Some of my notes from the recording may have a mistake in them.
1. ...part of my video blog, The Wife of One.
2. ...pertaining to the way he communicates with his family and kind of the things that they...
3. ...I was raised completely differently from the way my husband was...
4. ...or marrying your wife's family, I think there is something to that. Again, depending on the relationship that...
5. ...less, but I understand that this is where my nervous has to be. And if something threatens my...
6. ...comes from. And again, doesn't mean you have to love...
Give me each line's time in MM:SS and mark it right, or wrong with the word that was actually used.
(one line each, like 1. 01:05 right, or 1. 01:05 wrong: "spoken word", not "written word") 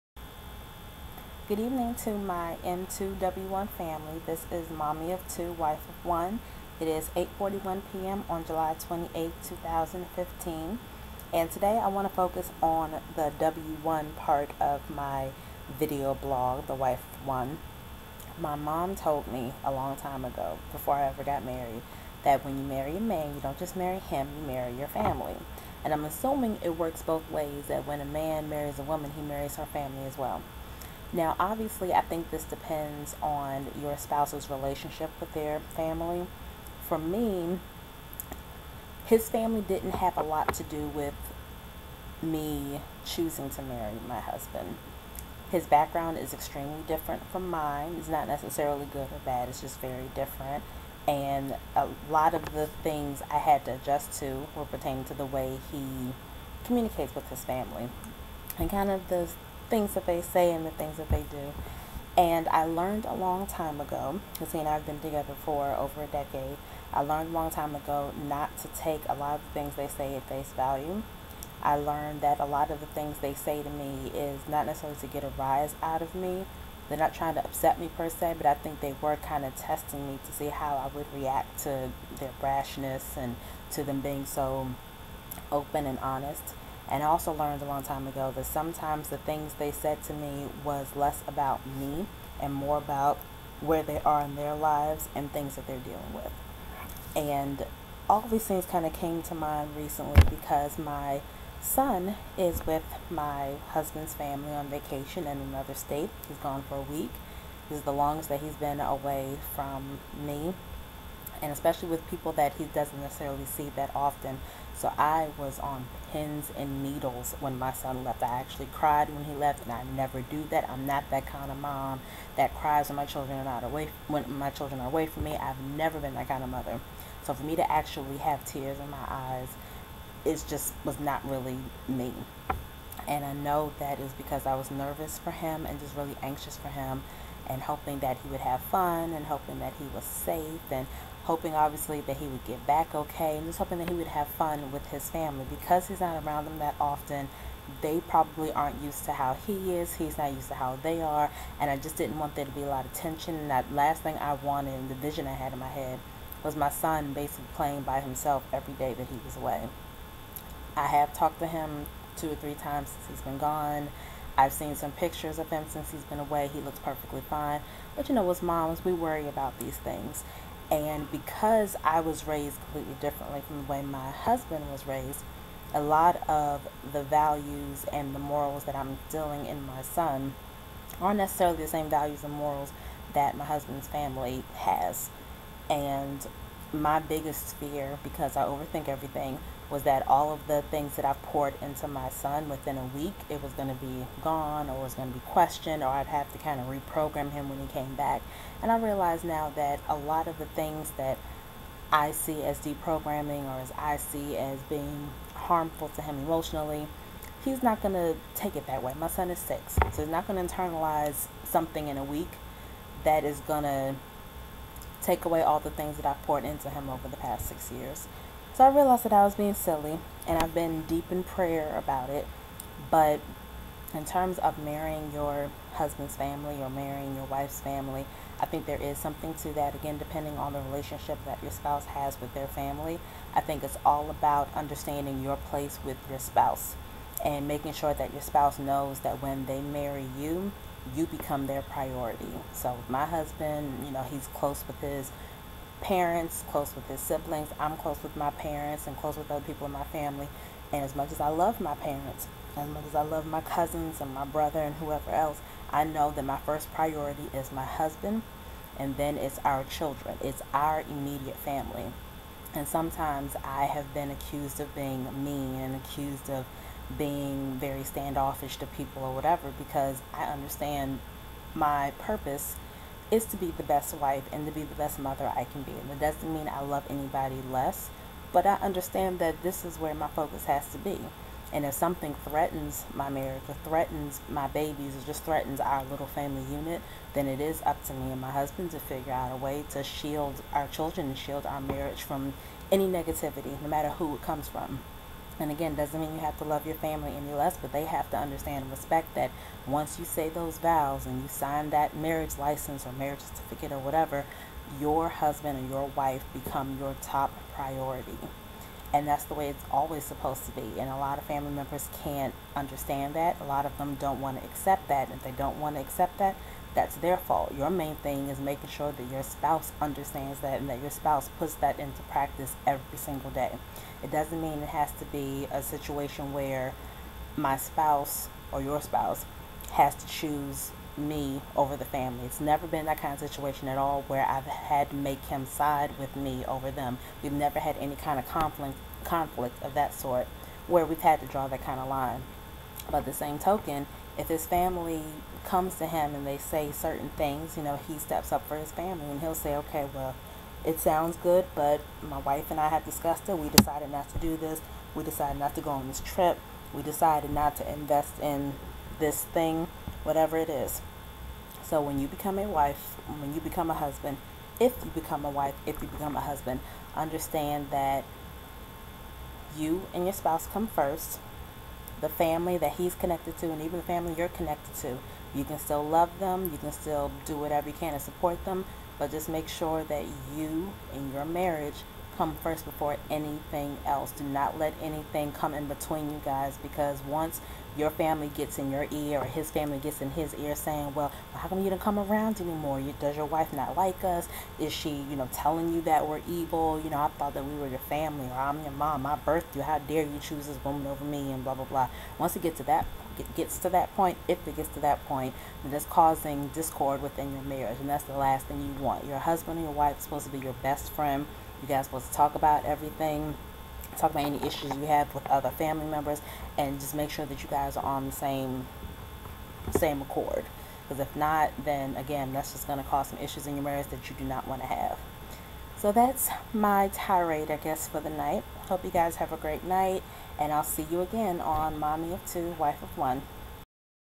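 1. 00:14 right
2. 00:54 right
3. 02:51 right
4. 03:46 right
5. 04:37 wrong: "focus", not "nervous"
6. 04:54 right.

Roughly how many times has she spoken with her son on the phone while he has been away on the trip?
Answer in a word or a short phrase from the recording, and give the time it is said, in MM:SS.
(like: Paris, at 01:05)
2 or 3, at 02:42.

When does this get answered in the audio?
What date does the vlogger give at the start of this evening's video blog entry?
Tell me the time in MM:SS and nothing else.
00:08.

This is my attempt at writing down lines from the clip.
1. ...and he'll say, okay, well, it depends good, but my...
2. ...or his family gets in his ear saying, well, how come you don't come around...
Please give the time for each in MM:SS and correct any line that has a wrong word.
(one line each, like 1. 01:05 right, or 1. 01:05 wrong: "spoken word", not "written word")
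1. 05:49 wrong: "sounds", not "depends"
2. 06:29 right.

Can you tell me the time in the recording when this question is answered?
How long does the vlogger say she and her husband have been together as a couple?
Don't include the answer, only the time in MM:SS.
01:05.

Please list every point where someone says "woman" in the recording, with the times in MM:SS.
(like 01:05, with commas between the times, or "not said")
00:28, 06:40.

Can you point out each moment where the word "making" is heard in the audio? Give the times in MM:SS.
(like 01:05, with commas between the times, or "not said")
03:57, 05:18.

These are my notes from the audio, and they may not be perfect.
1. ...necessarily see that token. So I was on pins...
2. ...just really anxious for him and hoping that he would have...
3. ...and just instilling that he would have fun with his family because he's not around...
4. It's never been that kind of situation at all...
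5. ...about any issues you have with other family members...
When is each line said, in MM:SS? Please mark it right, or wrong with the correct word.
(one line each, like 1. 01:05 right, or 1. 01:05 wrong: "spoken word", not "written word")
1. 01:53 wrong: "often", not "token"
2. 02:15 right
3. 02:23 wrong: "hoping", not "instilling"
4. 05:32 right
5. 06:54 right.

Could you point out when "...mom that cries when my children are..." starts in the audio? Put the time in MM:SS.
02:01.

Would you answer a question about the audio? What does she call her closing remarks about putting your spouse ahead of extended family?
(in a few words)
tirade.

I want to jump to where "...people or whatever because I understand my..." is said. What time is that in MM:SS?
04:28.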